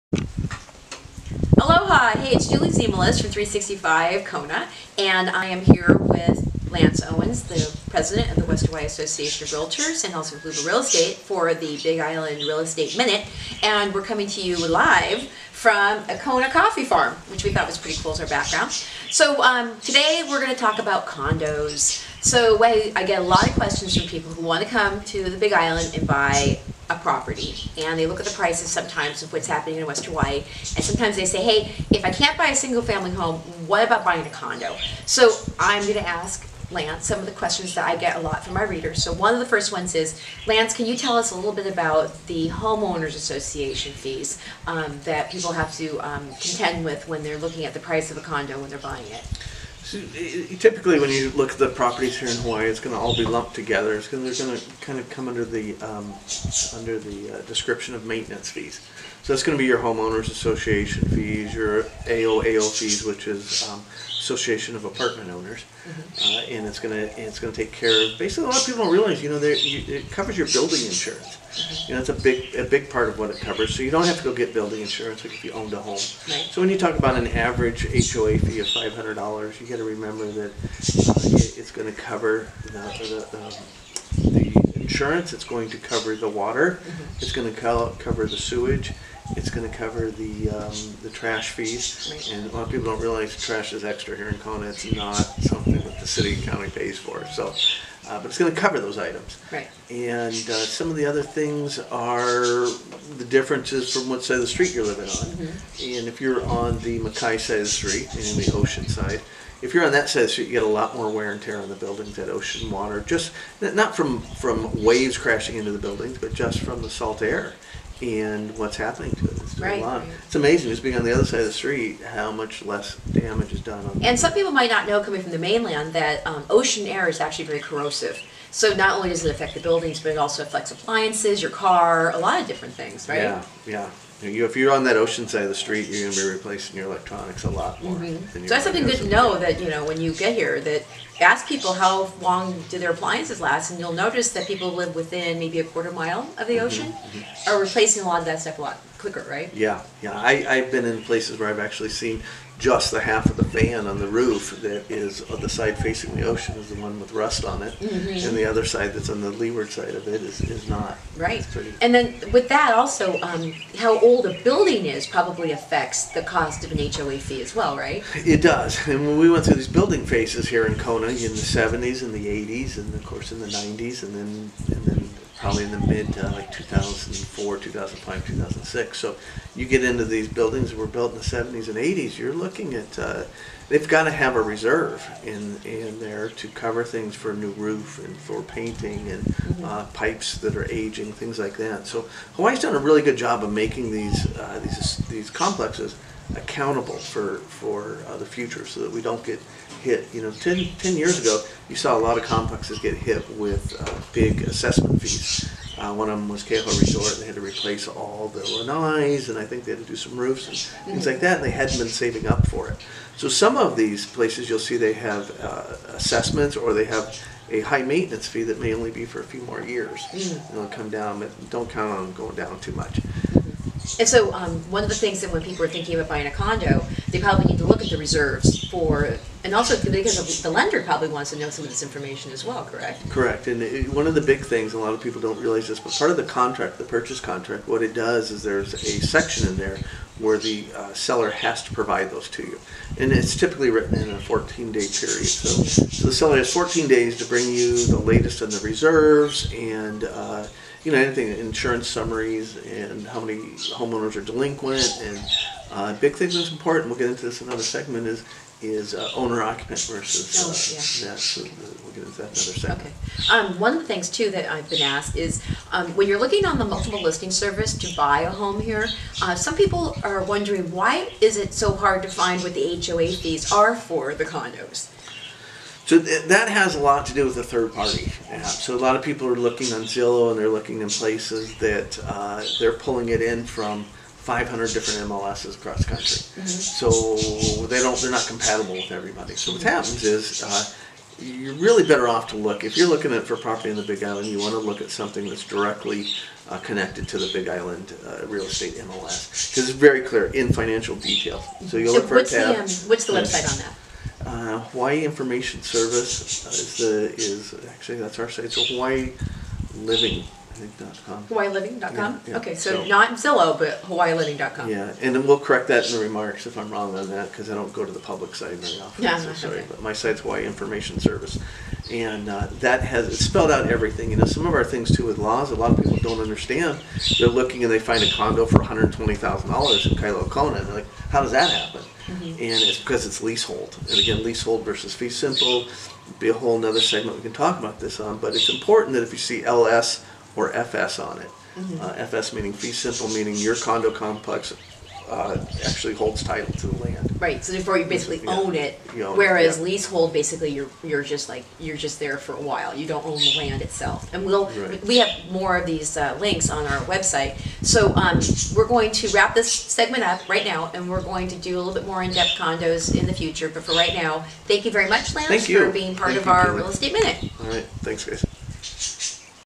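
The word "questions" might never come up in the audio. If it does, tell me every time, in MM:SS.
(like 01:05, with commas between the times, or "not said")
00:23, 00:37.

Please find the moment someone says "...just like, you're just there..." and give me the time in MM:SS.
05:51.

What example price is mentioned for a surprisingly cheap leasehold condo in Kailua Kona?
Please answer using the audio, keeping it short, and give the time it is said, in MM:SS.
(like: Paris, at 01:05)
$120,000, at 05:28.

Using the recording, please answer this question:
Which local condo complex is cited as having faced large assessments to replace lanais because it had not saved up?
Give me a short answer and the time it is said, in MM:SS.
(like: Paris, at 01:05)
Keauhou Resort, at 03:26.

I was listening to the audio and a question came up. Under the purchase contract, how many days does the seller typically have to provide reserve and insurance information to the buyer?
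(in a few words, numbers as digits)
14 days.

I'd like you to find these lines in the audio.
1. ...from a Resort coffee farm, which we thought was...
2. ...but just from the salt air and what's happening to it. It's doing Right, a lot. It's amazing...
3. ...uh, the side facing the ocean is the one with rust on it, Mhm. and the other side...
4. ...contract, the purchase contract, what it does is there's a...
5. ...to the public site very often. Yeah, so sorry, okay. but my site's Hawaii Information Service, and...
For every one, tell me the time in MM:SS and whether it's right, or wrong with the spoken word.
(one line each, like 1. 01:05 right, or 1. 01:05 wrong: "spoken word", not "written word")
1. 00:15 wrong: "Kona", not "Resort"
2. 01:56 right
3. 02:35 right
4. 03:56 right
5. 05:17 right.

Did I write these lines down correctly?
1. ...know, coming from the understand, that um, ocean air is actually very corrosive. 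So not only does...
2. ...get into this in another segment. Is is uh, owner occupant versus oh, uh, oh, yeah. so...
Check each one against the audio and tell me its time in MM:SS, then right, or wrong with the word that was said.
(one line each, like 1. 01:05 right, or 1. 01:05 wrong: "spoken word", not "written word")
1. 02:04 wrong: "mainland", not "understand"
2. 04:16 right.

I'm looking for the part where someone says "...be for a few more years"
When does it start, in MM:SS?
03:38.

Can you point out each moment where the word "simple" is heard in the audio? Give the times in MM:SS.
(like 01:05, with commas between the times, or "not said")
05:35, 05:42.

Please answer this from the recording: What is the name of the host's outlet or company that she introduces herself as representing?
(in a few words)
365 Kona.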